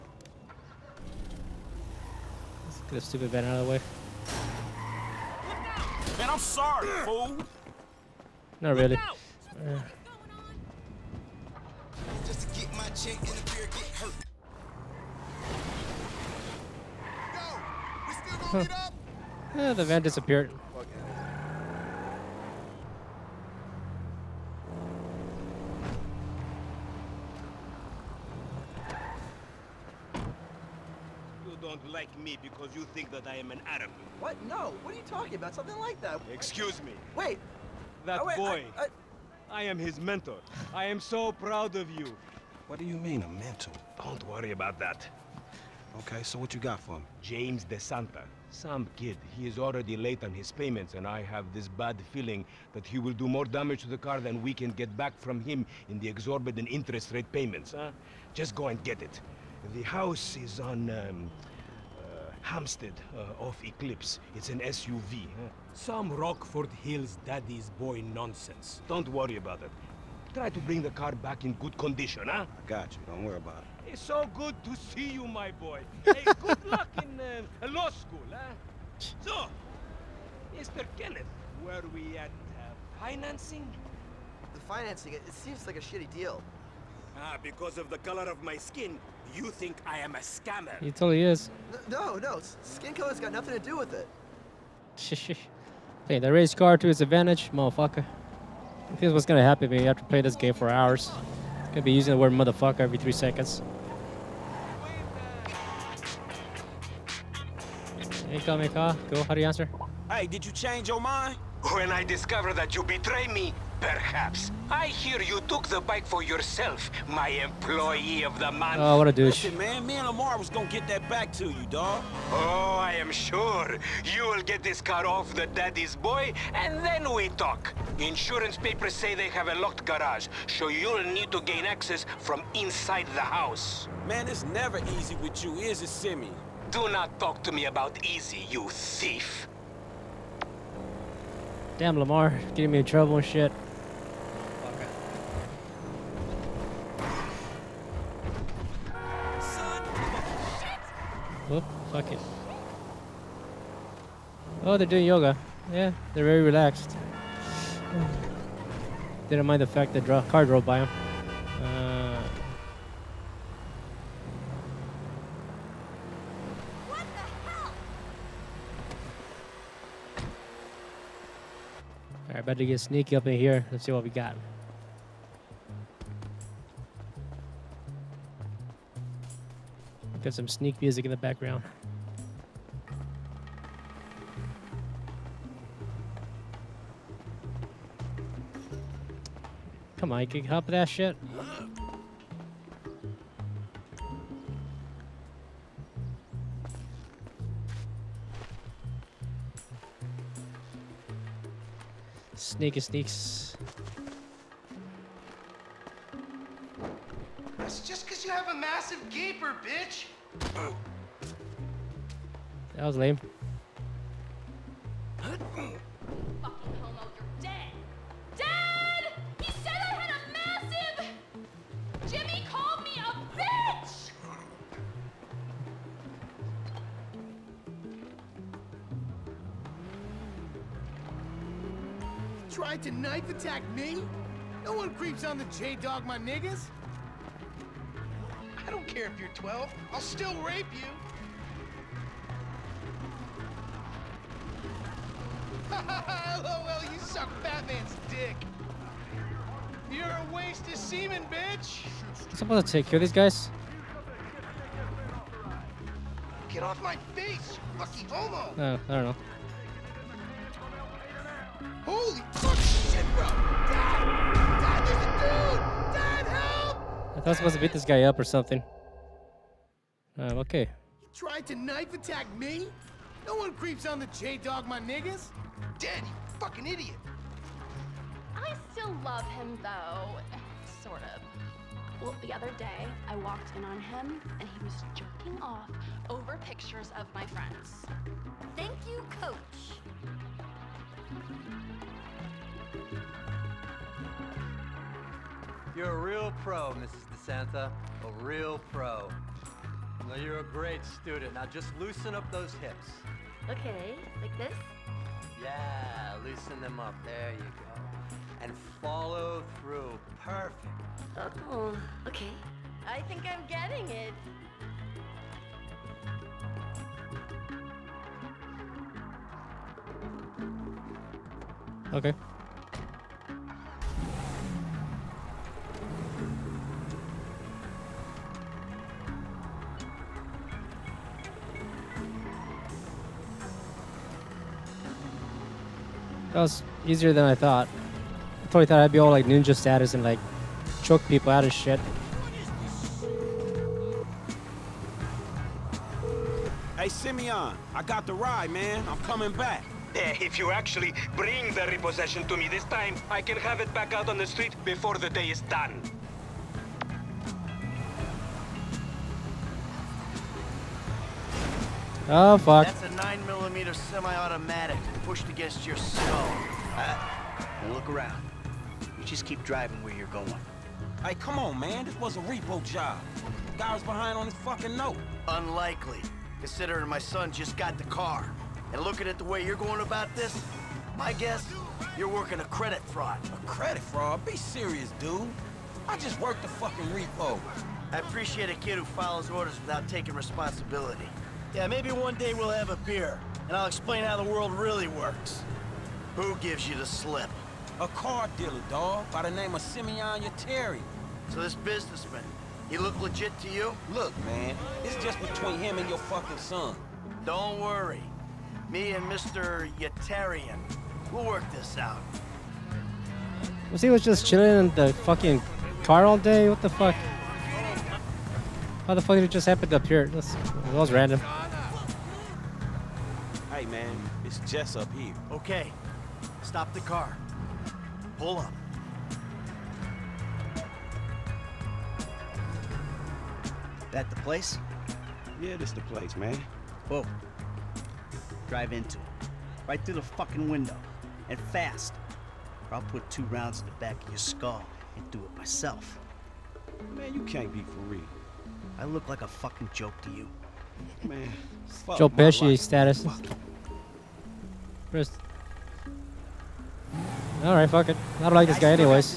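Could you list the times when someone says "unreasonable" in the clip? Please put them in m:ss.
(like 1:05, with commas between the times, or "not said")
not said.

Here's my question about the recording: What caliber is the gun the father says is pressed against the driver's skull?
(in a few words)
9 millimeter.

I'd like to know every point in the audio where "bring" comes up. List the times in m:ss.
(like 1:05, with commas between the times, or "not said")
1:10, 5:51.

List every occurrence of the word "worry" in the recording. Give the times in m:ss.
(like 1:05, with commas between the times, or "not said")
0:44, 1:09, 1:13, 6:47.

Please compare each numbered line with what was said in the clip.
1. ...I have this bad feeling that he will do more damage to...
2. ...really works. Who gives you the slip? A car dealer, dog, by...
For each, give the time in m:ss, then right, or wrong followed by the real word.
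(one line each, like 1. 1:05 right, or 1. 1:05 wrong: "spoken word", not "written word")
1. 0:51 right
2. 6:34 right.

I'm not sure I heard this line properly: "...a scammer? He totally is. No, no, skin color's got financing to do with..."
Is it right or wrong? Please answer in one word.
wrong.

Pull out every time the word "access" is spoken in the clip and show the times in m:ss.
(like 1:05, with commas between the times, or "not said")
2:11.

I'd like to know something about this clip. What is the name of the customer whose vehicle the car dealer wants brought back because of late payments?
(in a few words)
James DeSanta.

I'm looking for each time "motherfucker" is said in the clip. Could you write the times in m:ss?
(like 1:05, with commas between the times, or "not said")
1:37, 1:42.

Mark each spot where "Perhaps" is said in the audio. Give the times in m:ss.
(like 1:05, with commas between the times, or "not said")
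1:53.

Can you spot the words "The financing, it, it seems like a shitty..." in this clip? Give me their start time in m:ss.
1:24.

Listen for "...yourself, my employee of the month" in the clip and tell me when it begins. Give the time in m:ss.
1:56.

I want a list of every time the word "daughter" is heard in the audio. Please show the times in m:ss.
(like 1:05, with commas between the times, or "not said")
not said.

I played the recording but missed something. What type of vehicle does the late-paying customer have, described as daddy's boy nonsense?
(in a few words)
SUV.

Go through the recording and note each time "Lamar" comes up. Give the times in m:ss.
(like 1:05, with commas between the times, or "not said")
2:00, 2:21.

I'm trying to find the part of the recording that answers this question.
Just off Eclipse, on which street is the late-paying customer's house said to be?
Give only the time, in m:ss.
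1:02.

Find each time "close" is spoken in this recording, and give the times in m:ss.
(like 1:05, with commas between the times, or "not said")
not said.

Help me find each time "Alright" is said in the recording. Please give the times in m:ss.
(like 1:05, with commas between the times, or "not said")
2:52, 7:37.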